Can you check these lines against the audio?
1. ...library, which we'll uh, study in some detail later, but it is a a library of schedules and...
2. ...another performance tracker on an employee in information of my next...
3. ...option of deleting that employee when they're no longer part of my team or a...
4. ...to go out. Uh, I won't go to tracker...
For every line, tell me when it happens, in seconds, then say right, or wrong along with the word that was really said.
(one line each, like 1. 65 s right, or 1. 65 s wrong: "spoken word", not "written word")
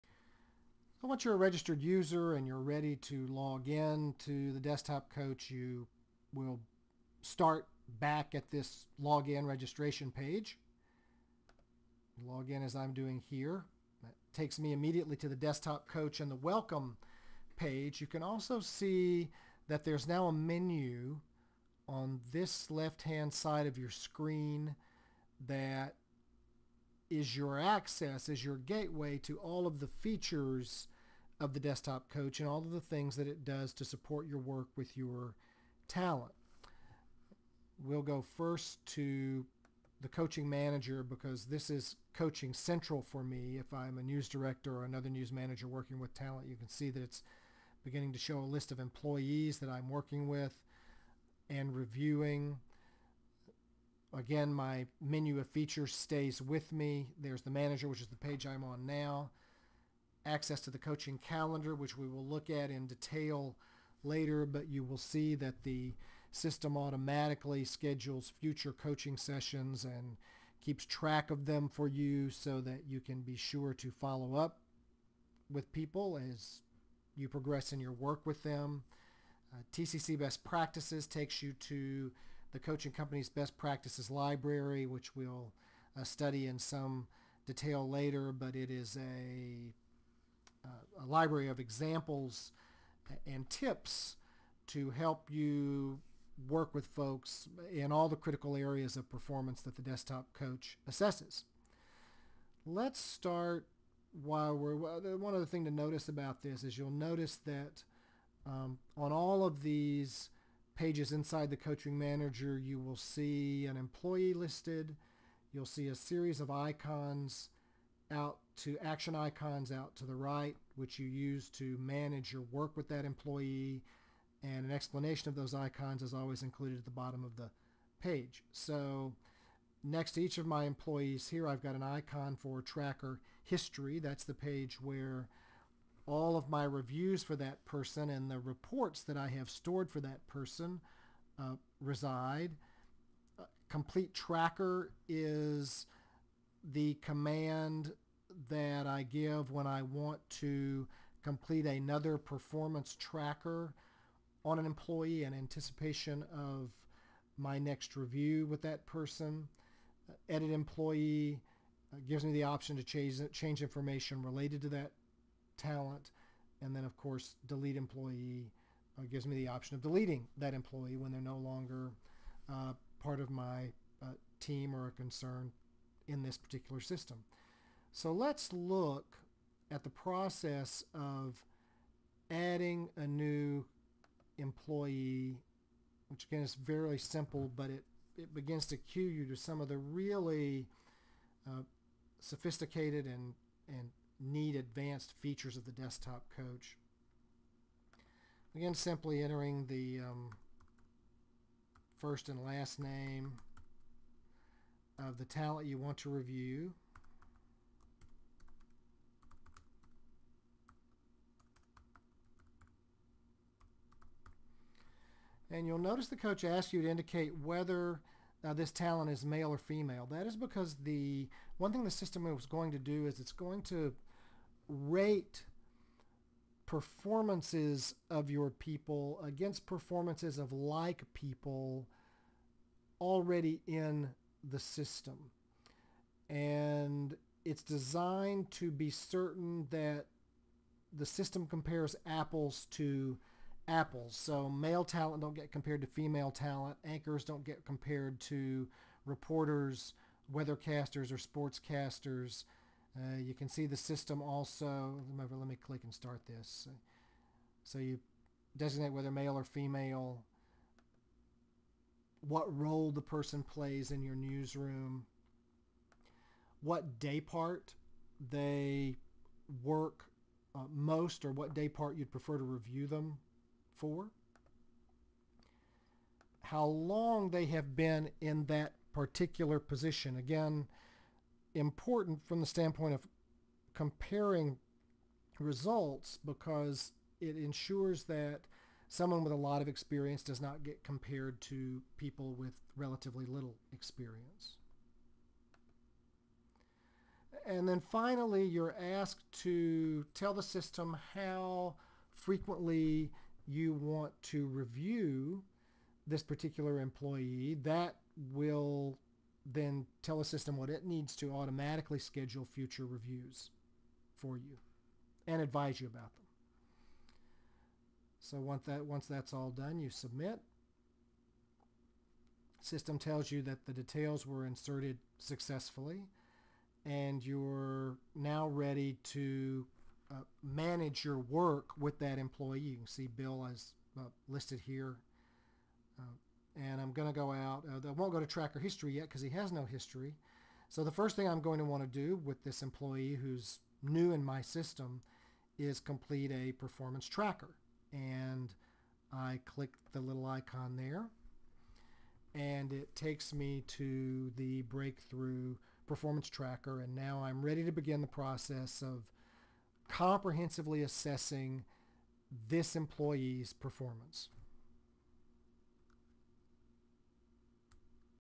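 1. 84 s wrong: "examples", not "schedules"
2. 151 s wrong: "anticipation", not "information"
3. 169 s right
4. 337 s right.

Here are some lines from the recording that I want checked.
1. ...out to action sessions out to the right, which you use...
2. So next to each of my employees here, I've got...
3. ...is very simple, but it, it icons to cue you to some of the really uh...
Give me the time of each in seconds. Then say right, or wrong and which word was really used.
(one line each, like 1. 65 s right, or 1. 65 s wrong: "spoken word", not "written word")
1. 118 s wrong: "icons", not "sessions"
2. 128 s right
3. 186 s wrong: "begins", not "icons".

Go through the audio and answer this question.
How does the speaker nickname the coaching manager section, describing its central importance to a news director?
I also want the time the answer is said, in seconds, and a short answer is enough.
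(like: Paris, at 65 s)
coaching central, at 42 s.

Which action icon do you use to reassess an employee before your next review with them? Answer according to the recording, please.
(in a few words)
complete tracker.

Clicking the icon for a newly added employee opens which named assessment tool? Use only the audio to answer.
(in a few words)
breakthrough performance tracker.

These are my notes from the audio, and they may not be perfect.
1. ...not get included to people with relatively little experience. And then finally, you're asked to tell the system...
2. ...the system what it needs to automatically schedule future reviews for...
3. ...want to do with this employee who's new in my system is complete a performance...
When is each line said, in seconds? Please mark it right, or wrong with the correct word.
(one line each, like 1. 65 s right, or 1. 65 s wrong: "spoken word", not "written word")
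1. 290 s wrong: "compared", not "included"
2. 310 s right
3. 341 s right.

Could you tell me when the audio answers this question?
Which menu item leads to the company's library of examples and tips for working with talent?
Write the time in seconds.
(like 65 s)
79 s.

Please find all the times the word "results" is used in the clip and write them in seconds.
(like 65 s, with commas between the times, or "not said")
285 s.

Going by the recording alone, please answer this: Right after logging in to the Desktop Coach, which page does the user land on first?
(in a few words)
Welcome page.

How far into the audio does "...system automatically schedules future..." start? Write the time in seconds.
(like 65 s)
66 s.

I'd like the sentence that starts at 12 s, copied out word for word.
Log in as I'm doing here.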